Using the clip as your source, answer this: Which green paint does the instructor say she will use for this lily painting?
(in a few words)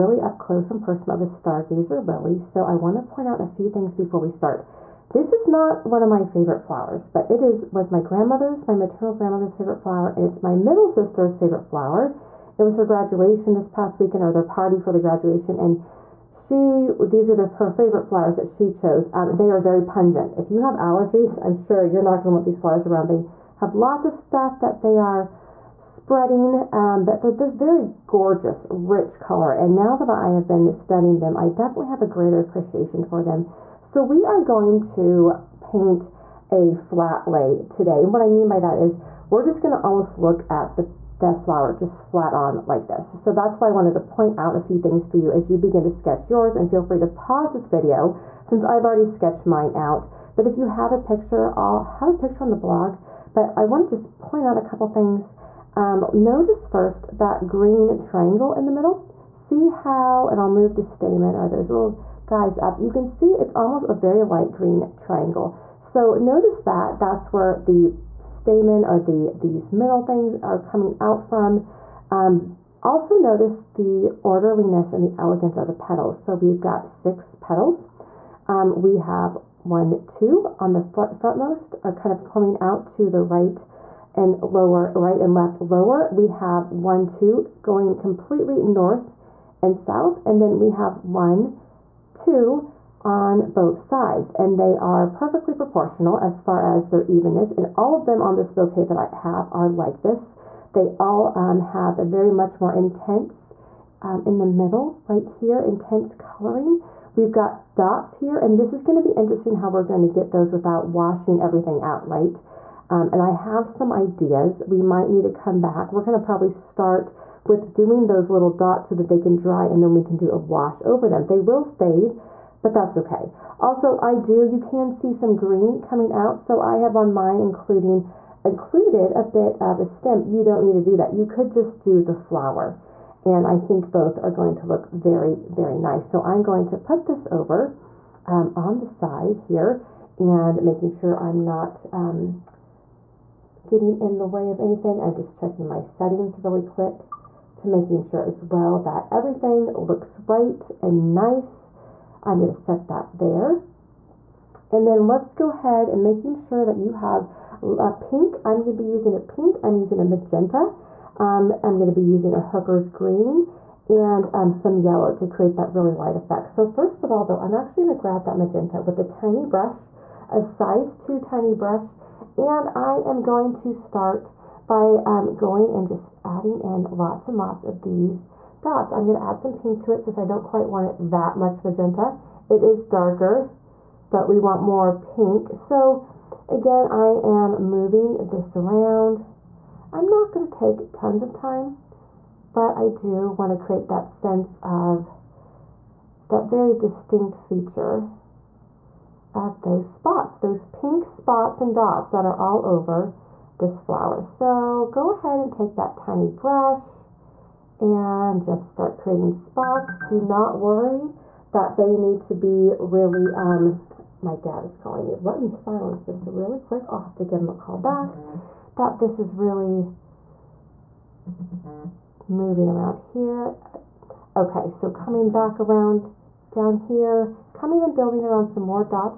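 Hooker's green.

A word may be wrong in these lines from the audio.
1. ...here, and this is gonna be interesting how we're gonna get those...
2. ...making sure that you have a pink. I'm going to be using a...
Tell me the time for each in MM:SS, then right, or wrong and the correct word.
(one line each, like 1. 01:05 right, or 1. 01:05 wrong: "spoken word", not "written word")
1. 01:48 right
2. 02:36 right.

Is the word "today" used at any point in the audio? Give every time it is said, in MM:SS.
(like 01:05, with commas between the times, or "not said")
00:37.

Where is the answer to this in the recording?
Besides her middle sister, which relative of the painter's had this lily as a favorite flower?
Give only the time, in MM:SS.
00:08.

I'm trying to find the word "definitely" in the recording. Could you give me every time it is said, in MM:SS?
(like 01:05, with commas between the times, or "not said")
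00:31.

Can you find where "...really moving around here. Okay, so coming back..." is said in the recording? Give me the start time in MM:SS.
03:39.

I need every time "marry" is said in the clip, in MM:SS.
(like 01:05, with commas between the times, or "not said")
not said.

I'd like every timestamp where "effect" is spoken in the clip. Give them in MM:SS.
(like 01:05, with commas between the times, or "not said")
02:46.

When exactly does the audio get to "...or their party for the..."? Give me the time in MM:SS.
00:14.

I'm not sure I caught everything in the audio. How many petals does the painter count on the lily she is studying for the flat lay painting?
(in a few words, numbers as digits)
6.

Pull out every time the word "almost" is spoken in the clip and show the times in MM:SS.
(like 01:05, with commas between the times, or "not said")
00:39, 01:03.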